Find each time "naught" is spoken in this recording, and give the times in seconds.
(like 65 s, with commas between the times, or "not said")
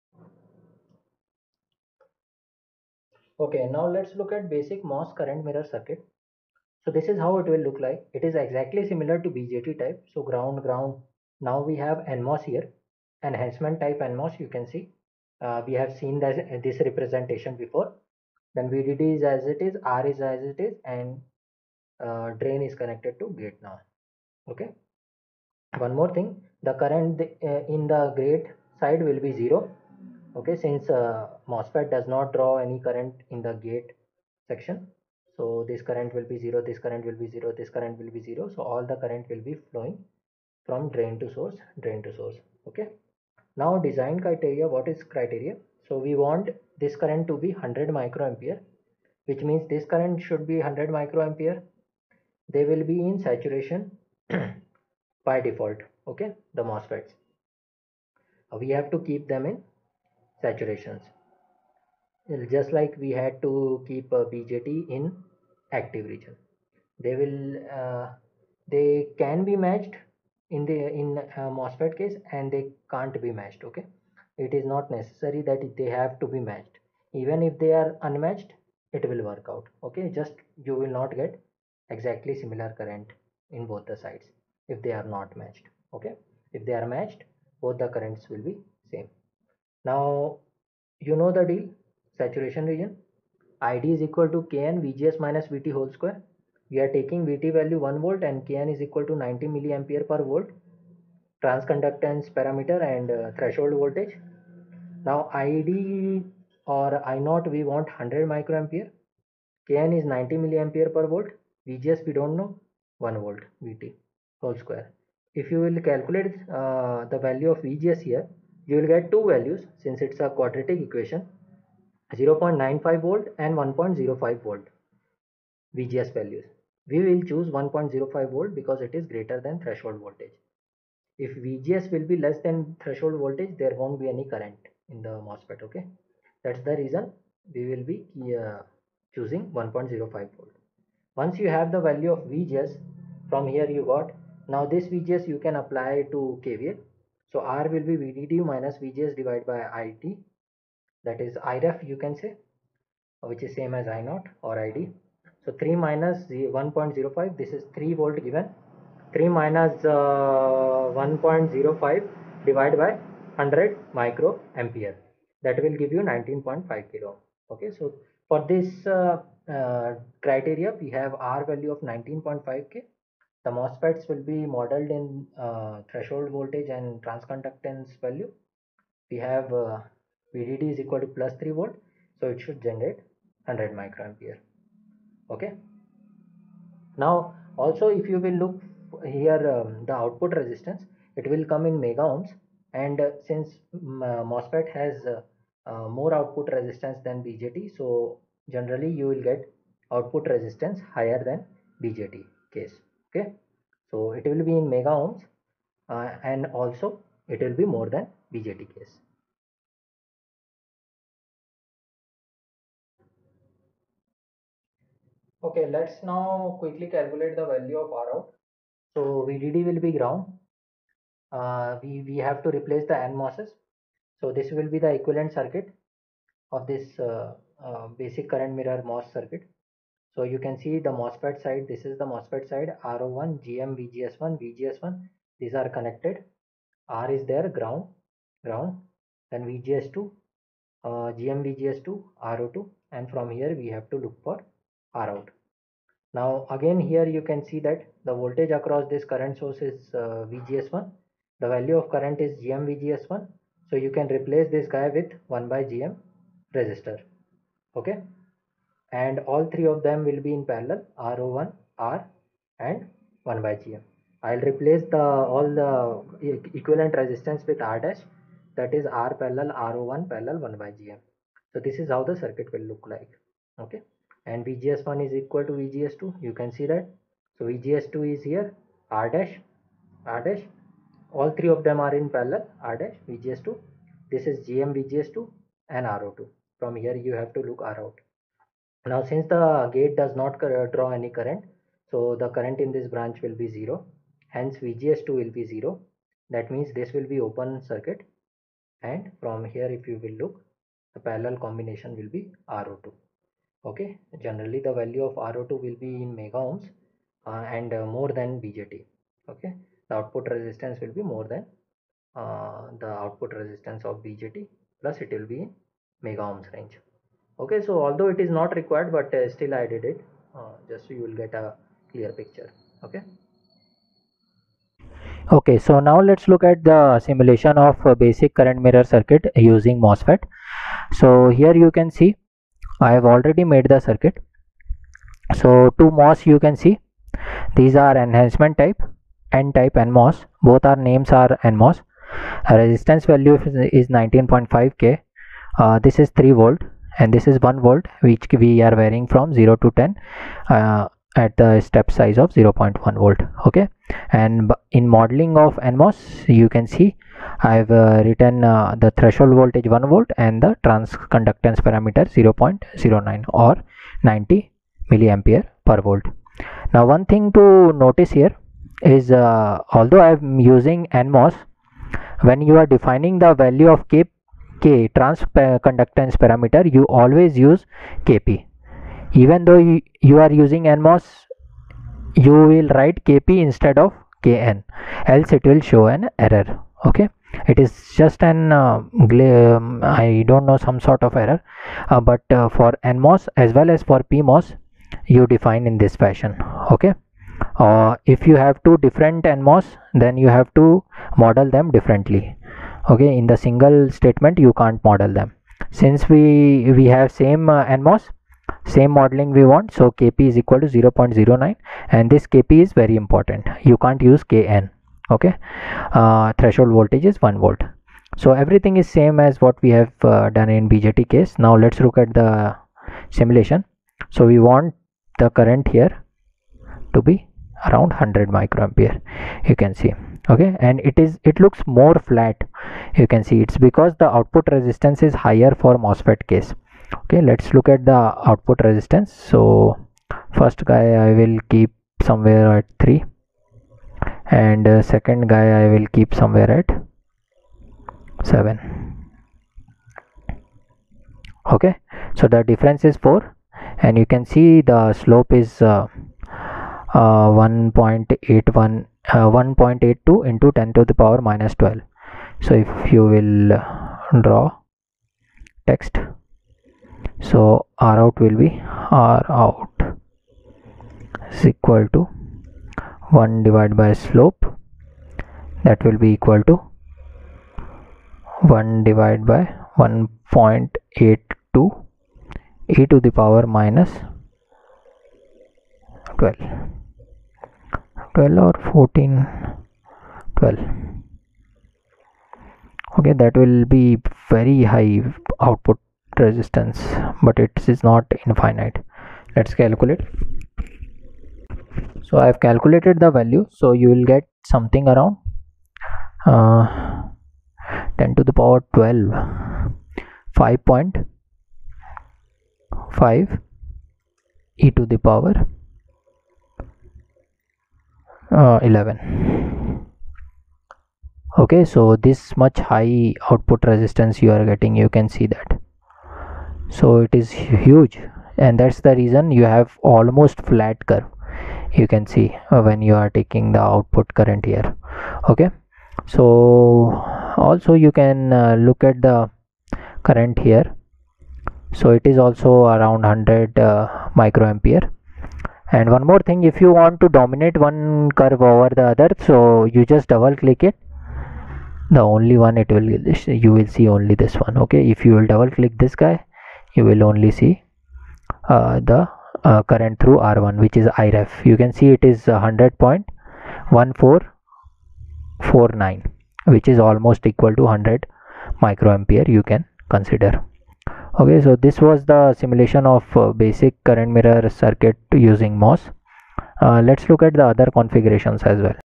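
107 s, 154 s.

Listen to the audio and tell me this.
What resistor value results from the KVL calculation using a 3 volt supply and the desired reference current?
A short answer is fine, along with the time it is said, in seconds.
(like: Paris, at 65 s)
19.5 kilo, at 166 s.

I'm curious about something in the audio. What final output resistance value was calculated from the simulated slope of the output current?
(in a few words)
5.5e11.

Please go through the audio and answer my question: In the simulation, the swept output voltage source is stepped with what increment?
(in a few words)
0.1 volt.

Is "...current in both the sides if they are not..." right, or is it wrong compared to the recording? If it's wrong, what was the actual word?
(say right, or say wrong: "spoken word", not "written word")
right.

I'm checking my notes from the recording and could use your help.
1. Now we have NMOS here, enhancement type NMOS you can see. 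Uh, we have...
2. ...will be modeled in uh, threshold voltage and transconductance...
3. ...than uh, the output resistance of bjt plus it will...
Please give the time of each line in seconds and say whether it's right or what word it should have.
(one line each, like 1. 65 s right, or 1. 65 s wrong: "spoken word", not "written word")
1. 11 s right
2. 174 s right
3. 311 s right.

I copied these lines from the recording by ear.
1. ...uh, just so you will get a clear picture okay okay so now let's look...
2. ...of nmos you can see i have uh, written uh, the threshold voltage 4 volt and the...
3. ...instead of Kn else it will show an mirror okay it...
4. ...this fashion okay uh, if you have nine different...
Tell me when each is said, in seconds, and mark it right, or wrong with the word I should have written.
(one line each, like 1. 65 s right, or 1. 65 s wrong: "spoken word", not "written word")
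1. 320 s right
2. 355 s wrong: "1", not "4"
3. 383 s wrong: "error", not "mirror"
4. 395 s wrong: "two", not "nine".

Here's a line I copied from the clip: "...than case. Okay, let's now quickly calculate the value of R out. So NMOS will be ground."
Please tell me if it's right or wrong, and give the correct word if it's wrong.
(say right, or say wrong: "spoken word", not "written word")
wrong: "VDD", not "NMOS".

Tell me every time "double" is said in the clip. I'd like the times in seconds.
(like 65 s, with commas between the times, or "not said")
550 s, 555 s.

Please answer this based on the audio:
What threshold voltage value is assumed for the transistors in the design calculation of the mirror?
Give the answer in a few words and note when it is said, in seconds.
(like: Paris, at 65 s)
1 volt, at 97 s.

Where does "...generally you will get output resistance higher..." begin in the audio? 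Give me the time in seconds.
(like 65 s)
198 s.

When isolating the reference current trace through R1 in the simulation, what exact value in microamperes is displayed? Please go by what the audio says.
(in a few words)
100.1449.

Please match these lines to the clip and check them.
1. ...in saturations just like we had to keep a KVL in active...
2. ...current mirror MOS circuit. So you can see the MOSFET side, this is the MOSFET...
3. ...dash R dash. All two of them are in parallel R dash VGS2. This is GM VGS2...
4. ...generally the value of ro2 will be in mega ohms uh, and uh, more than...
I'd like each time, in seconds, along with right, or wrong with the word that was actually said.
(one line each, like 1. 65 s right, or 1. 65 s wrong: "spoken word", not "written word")
1. 59 s wrong: "BJT", not "KVL"
2. 228 s right
3. 279 s wrong: "three", not "two"
4. 304 s right.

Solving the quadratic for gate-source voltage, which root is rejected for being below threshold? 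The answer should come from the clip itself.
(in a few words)
0.95 volt.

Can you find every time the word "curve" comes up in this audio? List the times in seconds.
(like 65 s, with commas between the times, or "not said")
530 s, 548 s.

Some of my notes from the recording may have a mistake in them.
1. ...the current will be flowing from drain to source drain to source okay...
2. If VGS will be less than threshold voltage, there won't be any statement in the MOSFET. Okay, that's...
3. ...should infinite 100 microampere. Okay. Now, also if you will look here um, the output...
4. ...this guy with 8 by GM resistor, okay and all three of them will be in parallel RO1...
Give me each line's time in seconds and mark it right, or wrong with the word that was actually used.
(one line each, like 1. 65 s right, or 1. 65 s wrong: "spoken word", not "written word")
1. 38 s right
2. 131 s wrong: "current", not "statement"
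3. 182 s wrong: "generate", not "infinite"
4. 254 s wrong: "1", not "8".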